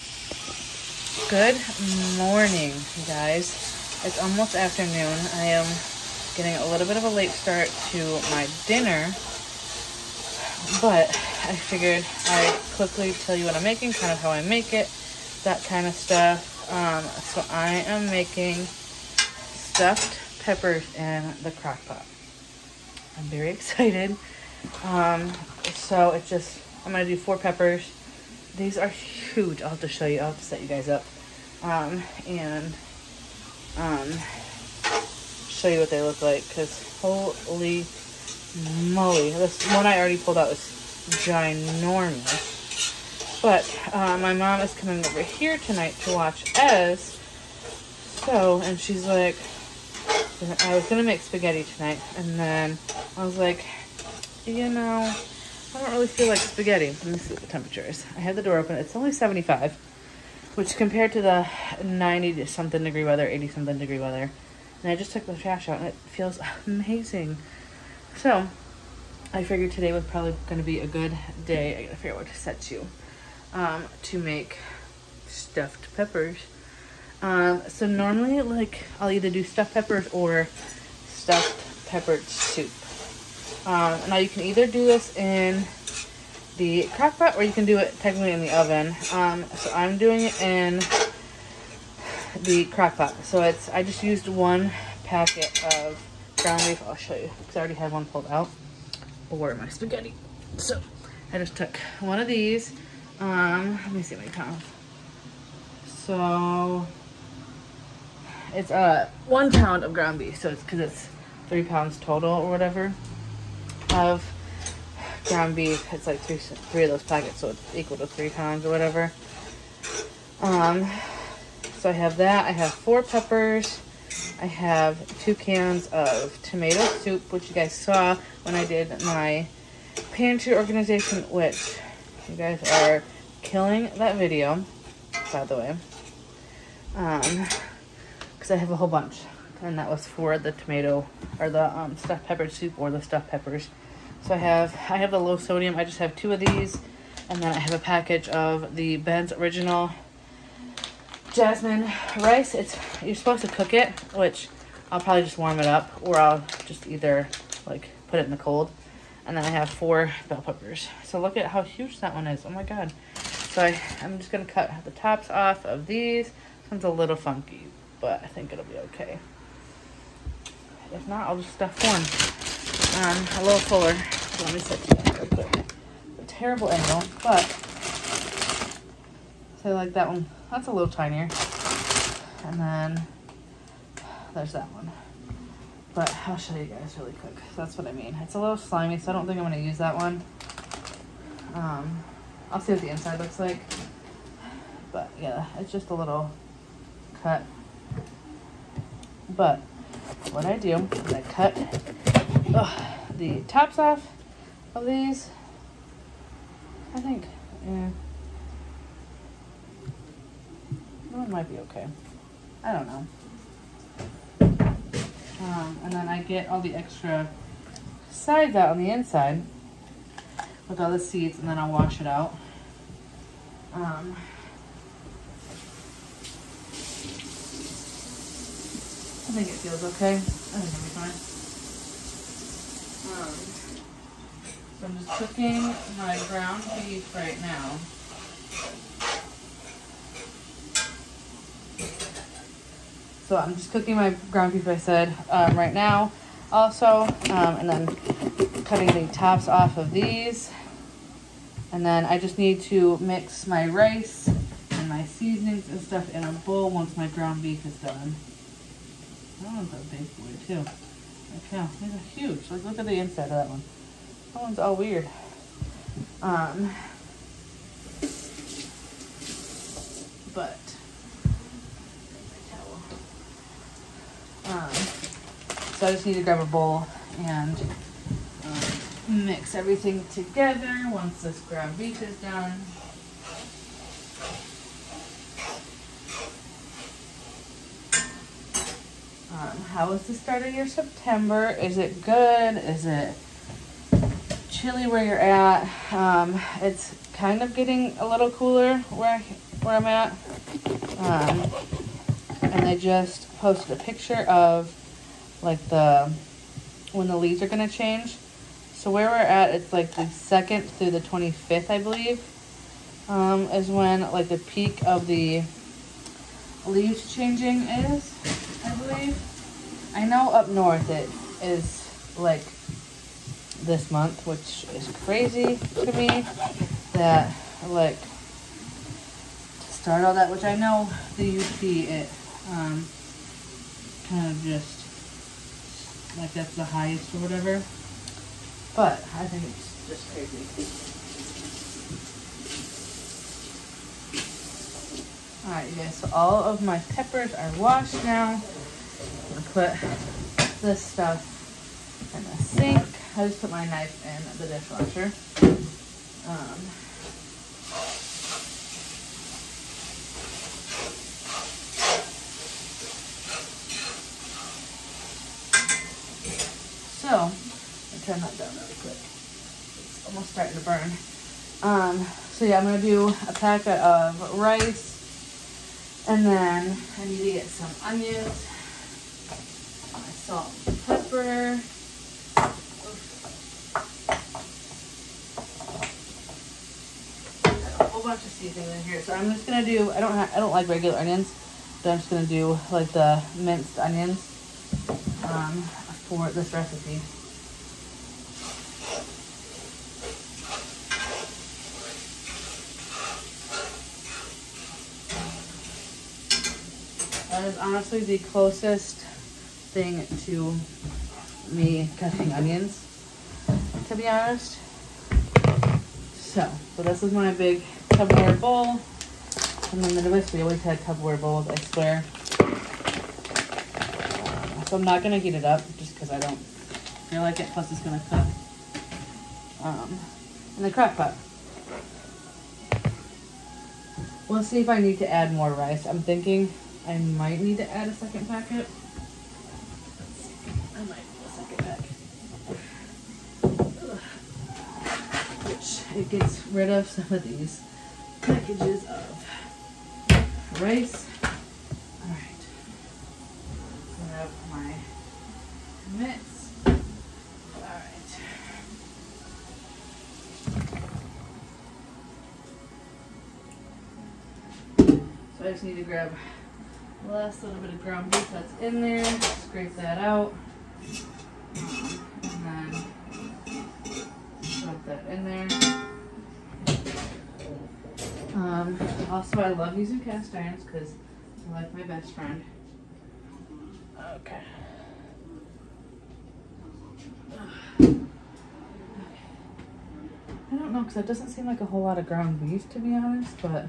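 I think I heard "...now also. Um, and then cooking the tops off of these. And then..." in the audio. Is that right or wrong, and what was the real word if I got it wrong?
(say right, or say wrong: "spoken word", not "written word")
wrong: "cutting", not "cooking".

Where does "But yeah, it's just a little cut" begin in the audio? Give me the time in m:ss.
3:14.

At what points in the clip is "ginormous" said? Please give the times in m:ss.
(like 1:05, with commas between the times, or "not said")
0:41.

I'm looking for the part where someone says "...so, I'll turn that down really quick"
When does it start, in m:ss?
6:06.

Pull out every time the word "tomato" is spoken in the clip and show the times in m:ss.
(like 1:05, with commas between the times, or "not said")
2:06, 2:20.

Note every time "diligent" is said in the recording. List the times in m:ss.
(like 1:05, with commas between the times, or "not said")
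not said.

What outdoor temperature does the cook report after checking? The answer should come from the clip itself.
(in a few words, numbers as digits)
75.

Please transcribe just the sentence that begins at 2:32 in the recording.
It's, you're supposed to cook it, which I'll probably just warm it up.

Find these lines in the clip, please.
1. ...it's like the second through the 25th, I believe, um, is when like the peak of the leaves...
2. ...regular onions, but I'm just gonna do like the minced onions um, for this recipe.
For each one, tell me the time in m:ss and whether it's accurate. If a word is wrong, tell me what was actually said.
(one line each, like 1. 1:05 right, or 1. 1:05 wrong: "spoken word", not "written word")
1. 5:09 right
2. 6:30 right.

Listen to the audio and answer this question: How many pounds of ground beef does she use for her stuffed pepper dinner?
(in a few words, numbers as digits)
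1 pound.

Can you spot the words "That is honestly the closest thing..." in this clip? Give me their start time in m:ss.
6:47.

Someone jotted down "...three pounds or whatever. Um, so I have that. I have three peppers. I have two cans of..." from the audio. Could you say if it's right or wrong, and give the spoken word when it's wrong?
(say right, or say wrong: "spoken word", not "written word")
wrong: "four", not "three".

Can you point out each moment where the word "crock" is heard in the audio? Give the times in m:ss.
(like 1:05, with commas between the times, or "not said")
0:21, 1:26, 1:32, 7:10.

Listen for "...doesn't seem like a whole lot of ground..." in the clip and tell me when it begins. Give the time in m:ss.
8:11.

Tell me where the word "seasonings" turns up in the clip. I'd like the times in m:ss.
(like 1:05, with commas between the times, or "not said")
4:15, 6:28.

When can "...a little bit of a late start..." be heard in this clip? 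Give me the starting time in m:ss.
0:06.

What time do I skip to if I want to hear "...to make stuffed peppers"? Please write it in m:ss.
1:14.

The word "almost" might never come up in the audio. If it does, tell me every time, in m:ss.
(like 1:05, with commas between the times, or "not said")
0:04, 6:10.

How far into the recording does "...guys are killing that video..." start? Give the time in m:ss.
2:12.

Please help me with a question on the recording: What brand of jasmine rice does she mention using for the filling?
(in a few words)
Ben's Original.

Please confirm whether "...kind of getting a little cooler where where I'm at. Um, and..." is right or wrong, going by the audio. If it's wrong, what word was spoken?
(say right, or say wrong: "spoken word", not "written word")
right.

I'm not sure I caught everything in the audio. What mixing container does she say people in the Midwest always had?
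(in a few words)
Tupperware bowl.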